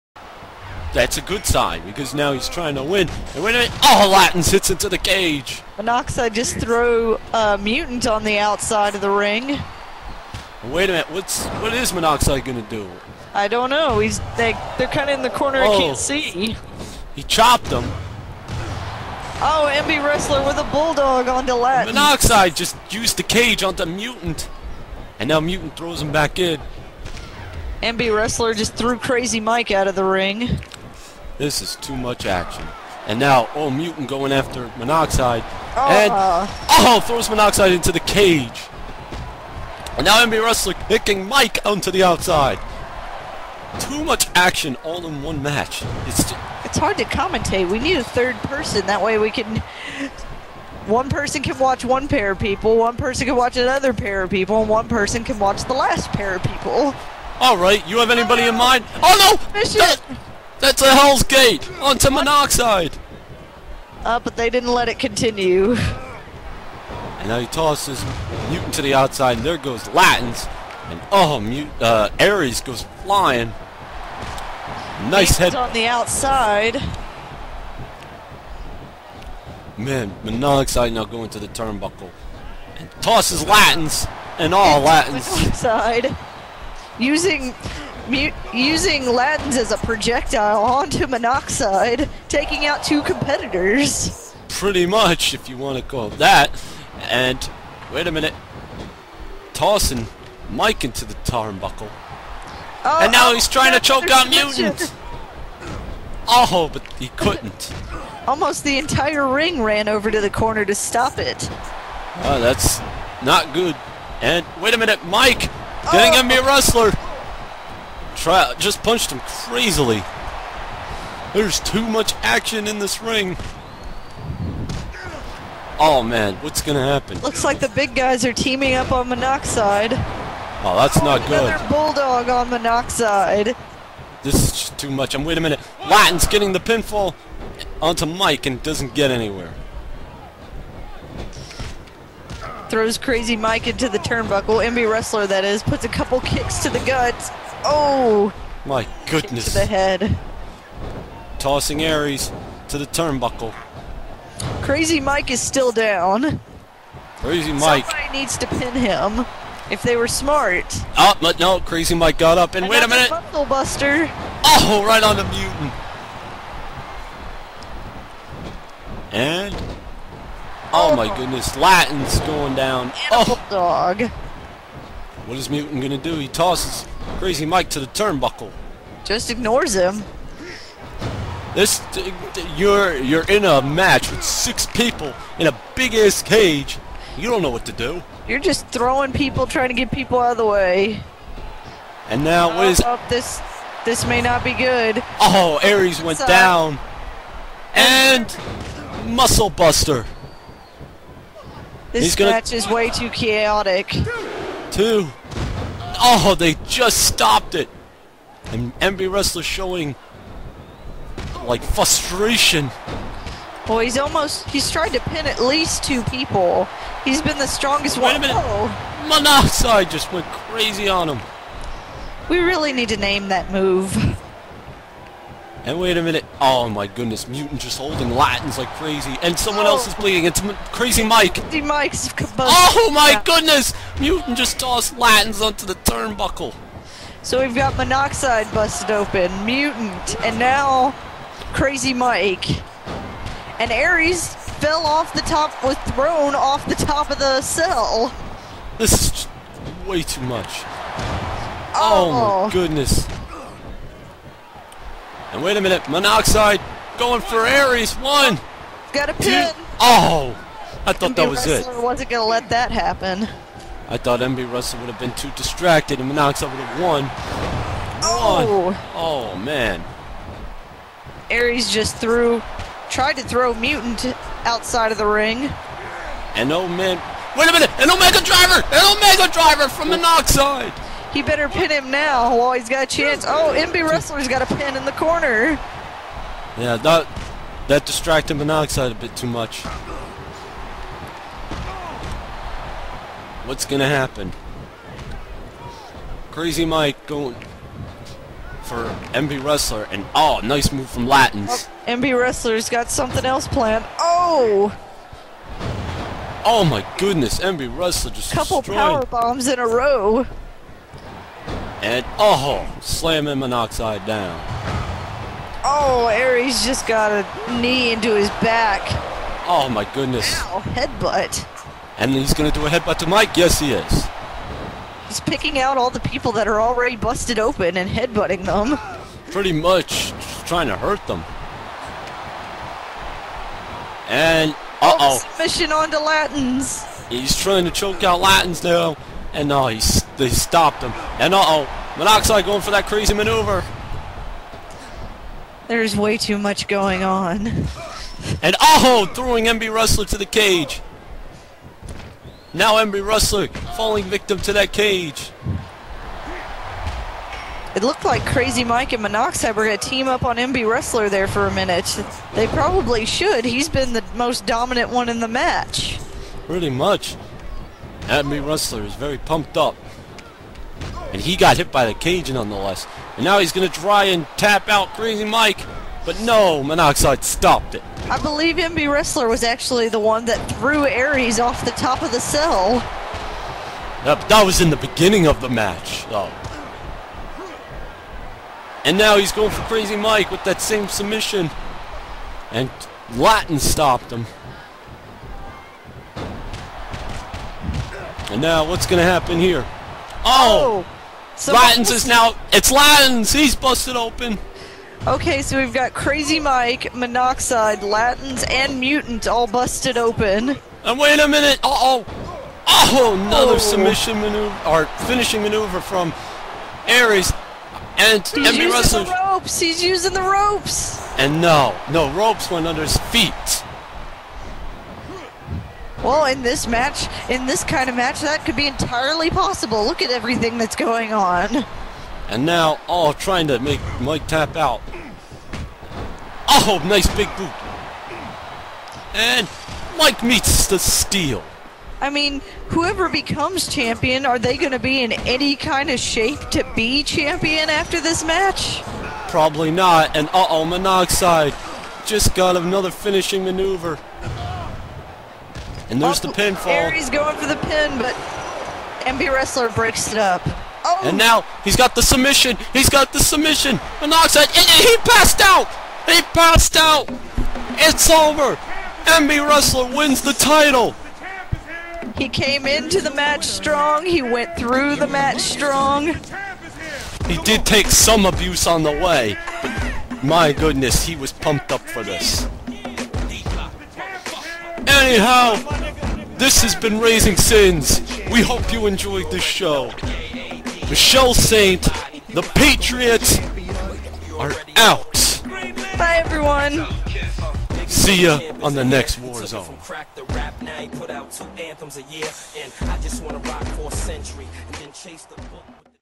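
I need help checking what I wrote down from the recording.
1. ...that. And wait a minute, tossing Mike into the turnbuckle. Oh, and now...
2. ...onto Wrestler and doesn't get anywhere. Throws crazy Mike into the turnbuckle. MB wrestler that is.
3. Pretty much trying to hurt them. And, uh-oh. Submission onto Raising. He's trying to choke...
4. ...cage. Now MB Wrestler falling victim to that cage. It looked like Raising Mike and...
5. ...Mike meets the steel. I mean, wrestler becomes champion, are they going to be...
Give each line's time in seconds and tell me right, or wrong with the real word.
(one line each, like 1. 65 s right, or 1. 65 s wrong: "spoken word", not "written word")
1. 96 s right
2. 137 s wrong: "Mike", not "Wrestler"
3. 329 s wrong: "Latins", not "Raising"
4. 350 s wrong: "Crazy", not "Raising"
5. 439 s wrong: "whoever", not "wrestler".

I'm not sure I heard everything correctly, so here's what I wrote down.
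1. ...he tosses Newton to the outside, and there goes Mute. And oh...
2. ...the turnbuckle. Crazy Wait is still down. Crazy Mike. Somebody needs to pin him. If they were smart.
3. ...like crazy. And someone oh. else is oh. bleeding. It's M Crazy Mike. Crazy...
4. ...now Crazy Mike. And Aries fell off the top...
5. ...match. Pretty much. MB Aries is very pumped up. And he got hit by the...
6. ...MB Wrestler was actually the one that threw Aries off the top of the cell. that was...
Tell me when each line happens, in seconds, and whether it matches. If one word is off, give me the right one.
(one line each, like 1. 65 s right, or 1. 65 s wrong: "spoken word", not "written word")
1. 67 s wrong: "Latins", not "Mute"
2. 152 s wrong: "Mike", not "Wait"
3. 228 s right
4. 240 s right
5. 365 s wrong: "Wrestler", not "Aries"
6. 378 s right.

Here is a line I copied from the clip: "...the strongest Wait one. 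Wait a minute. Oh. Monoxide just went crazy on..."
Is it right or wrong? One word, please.
right.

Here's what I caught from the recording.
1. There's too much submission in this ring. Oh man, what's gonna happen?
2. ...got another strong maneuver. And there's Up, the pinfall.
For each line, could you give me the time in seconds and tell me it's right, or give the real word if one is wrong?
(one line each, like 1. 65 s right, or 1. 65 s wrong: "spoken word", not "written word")
1. 121 s wrong: "action", not "submission"
2. 452 s wrong: "finishing", not "strong".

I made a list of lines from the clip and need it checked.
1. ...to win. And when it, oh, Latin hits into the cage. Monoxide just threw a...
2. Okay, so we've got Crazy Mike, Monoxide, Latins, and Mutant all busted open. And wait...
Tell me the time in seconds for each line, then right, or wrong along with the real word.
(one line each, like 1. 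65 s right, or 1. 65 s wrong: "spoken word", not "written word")
1. 2 s right
2. 405 s right.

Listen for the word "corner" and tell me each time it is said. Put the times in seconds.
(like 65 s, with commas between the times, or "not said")
15 s, 110 s, 284 s.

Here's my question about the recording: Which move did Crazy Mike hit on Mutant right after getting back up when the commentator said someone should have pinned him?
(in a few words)
Bundle Buster.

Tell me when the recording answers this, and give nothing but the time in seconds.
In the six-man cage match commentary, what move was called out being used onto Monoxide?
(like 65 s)
60 s.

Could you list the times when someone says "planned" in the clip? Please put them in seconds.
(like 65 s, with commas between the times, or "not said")
303 s.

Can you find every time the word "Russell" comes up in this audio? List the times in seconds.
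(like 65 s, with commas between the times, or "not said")
418 s.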